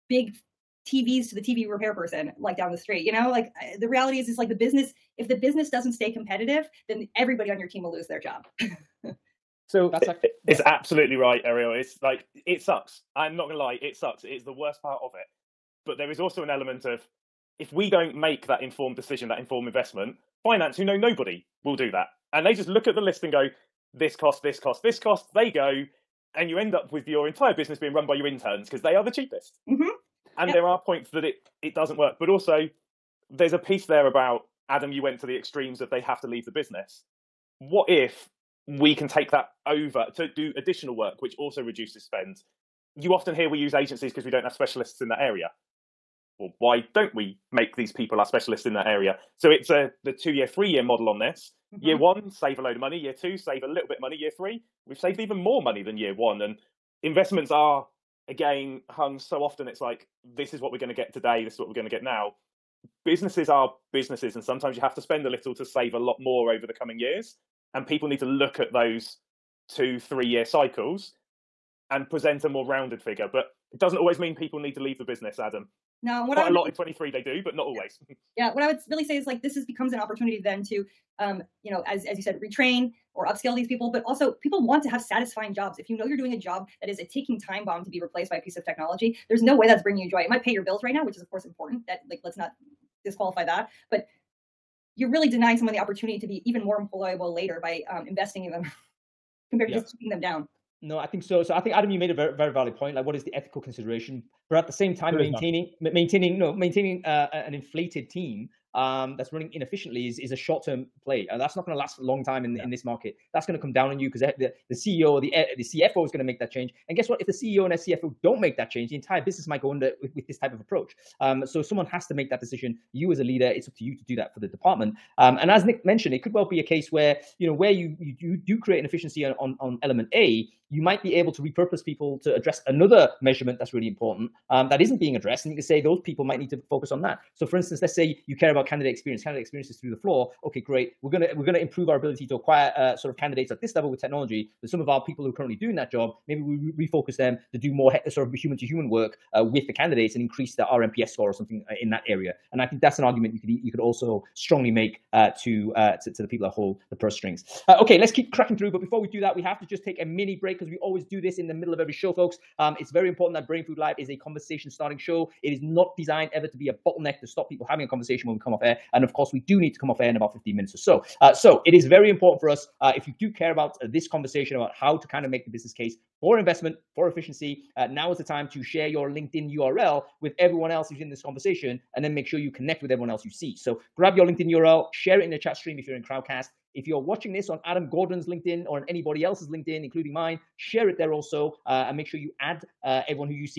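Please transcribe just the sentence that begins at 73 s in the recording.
But it doesn't always mean people need to leave the business, Adam.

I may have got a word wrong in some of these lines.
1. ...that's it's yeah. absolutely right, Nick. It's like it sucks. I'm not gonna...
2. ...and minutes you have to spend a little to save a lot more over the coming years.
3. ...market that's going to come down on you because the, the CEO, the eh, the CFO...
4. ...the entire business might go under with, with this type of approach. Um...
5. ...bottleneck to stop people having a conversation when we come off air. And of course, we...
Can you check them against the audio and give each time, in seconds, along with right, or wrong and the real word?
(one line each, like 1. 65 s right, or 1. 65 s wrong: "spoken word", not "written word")
1. 9 s wrong: "Arielle", not "Nick"
2. 64 s wrong: "sometimes", not "minutes"
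3. 112 s right
4. 118 s right
5. 166 s right.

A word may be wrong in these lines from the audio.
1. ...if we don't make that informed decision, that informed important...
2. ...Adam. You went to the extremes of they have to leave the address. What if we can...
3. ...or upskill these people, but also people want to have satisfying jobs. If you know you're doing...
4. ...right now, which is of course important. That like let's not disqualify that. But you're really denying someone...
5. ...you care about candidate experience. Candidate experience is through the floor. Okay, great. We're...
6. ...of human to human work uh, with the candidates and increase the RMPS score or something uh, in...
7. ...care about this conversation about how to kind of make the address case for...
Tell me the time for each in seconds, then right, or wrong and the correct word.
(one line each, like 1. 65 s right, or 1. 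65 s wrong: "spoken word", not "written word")
1. 17 s wrong: "investment", not "important"
2. 34 s wrong: "business", not "address"
3. 83 s right
4. 90 s right
5. 138 s right
6. 148 s right
7. 173 s wrong: "business", not "address".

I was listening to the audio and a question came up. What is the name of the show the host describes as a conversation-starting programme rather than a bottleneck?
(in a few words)
Brainfood Live.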